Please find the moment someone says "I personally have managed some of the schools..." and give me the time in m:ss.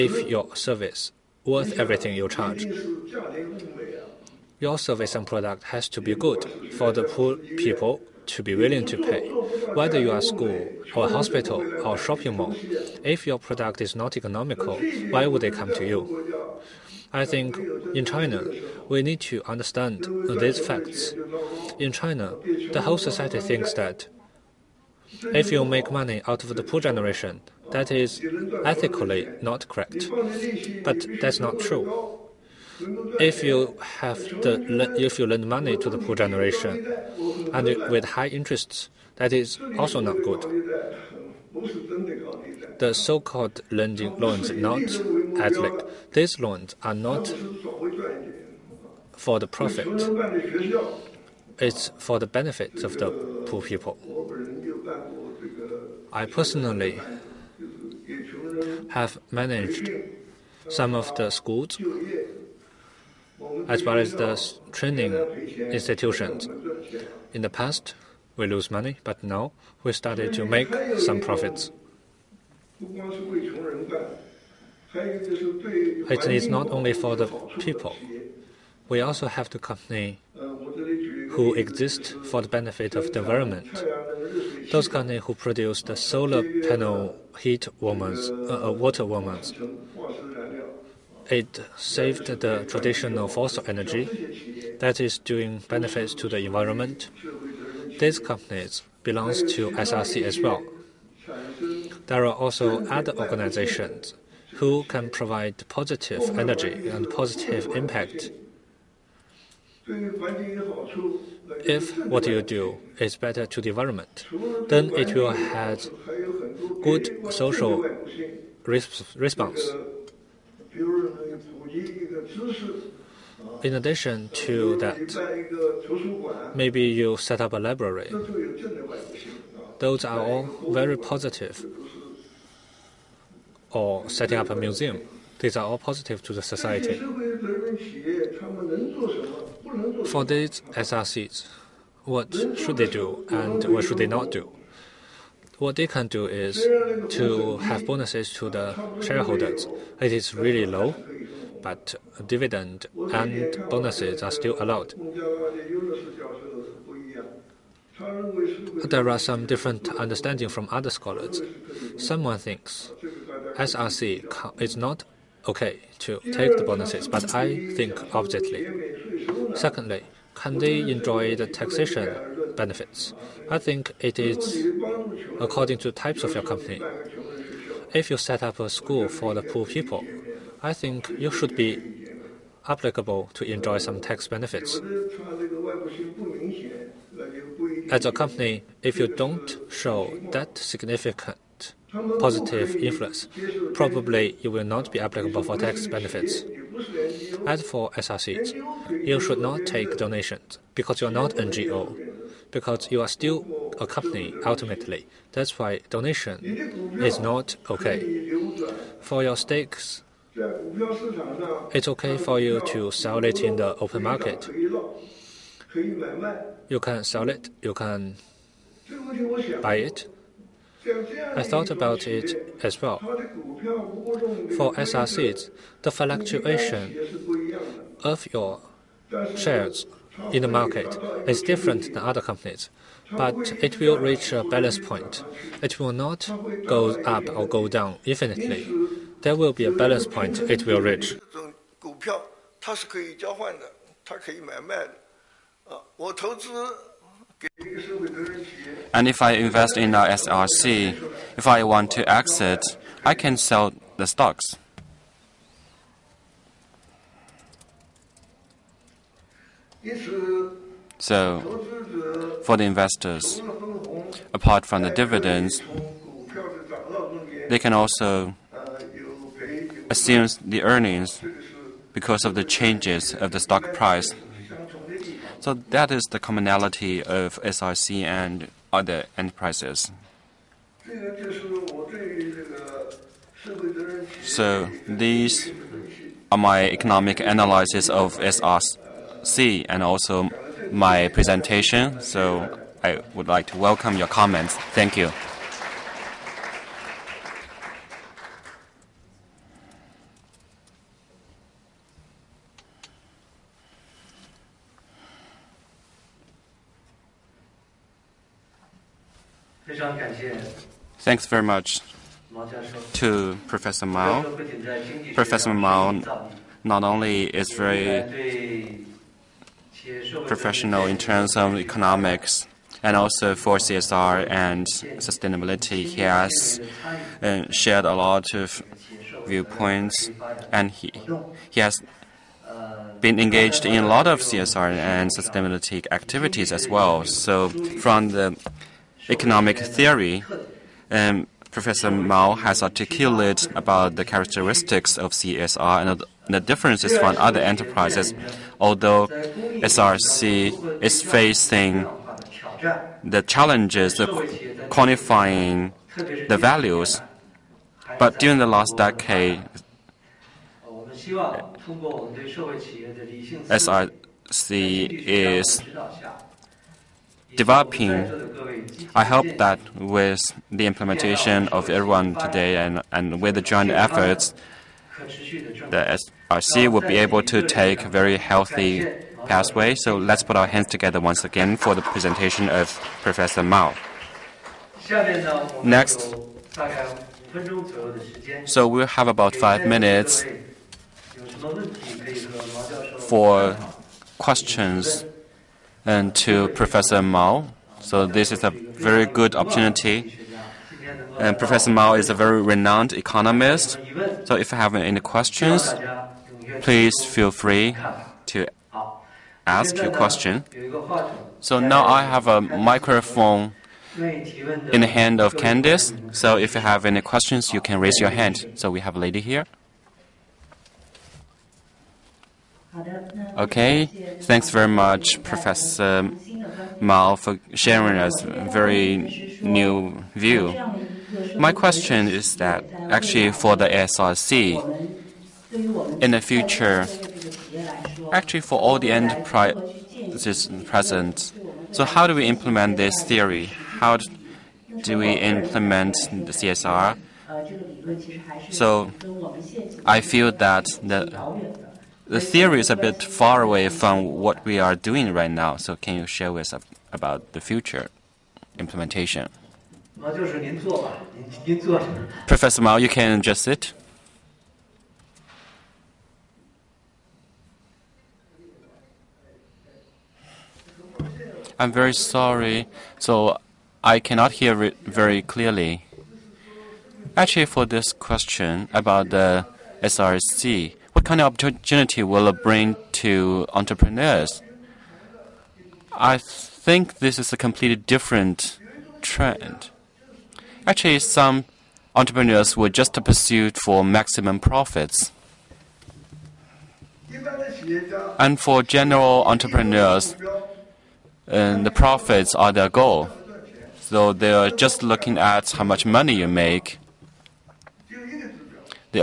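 0:56.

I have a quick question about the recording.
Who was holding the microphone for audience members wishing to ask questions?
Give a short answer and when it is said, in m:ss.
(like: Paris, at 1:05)
Candice, at 6:53.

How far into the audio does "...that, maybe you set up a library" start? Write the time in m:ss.
2:04.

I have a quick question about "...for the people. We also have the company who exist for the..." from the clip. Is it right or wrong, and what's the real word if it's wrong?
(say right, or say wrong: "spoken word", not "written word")
right.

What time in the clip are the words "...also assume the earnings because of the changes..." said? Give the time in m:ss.
4:27.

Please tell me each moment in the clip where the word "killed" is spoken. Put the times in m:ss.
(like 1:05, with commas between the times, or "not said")
not said.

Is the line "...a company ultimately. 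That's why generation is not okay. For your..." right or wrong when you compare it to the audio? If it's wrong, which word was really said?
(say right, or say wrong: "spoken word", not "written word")
wrong: "donation", not "generation".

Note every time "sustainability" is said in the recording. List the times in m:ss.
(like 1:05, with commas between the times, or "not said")
5:25, 5:35.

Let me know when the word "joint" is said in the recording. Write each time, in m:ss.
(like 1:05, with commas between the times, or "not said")
6:13.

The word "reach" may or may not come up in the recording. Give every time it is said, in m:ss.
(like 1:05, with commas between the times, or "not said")
3:53, 4:00.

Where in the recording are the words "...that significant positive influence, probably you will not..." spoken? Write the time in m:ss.
3:10.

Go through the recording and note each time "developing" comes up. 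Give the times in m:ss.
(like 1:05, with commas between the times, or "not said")
6:07.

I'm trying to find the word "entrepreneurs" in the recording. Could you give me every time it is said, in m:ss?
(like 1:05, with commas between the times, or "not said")
8:03, 8:11, 8:19.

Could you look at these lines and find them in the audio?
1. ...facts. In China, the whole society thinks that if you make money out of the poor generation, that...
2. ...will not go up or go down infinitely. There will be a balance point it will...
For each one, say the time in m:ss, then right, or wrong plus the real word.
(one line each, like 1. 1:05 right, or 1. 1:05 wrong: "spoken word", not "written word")
1. 0:20 right
2. 3:55 right.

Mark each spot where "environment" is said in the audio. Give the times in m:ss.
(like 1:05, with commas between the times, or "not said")
1:23, 1:36, 1:53.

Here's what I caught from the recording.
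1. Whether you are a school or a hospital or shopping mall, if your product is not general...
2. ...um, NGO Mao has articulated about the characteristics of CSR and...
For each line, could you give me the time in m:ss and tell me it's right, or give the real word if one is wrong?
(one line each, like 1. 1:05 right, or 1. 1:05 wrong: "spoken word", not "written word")
1. 0:09 wrong: "economical", not "general"
2. 5:40 wrong: "Professor", not "NGO".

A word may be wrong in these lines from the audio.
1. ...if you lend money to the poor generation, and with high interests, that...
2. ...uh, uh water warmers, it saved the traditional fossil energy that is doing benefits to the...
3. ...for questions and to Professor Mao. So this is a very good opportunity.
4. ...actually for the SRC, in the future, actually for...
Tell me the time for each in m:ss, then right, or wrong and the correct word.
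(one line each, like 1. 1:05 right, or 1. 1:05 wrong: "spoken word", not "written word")
1. 0:35 right
2. 1:28 right
3. 6:33 right
4. 7:12 right.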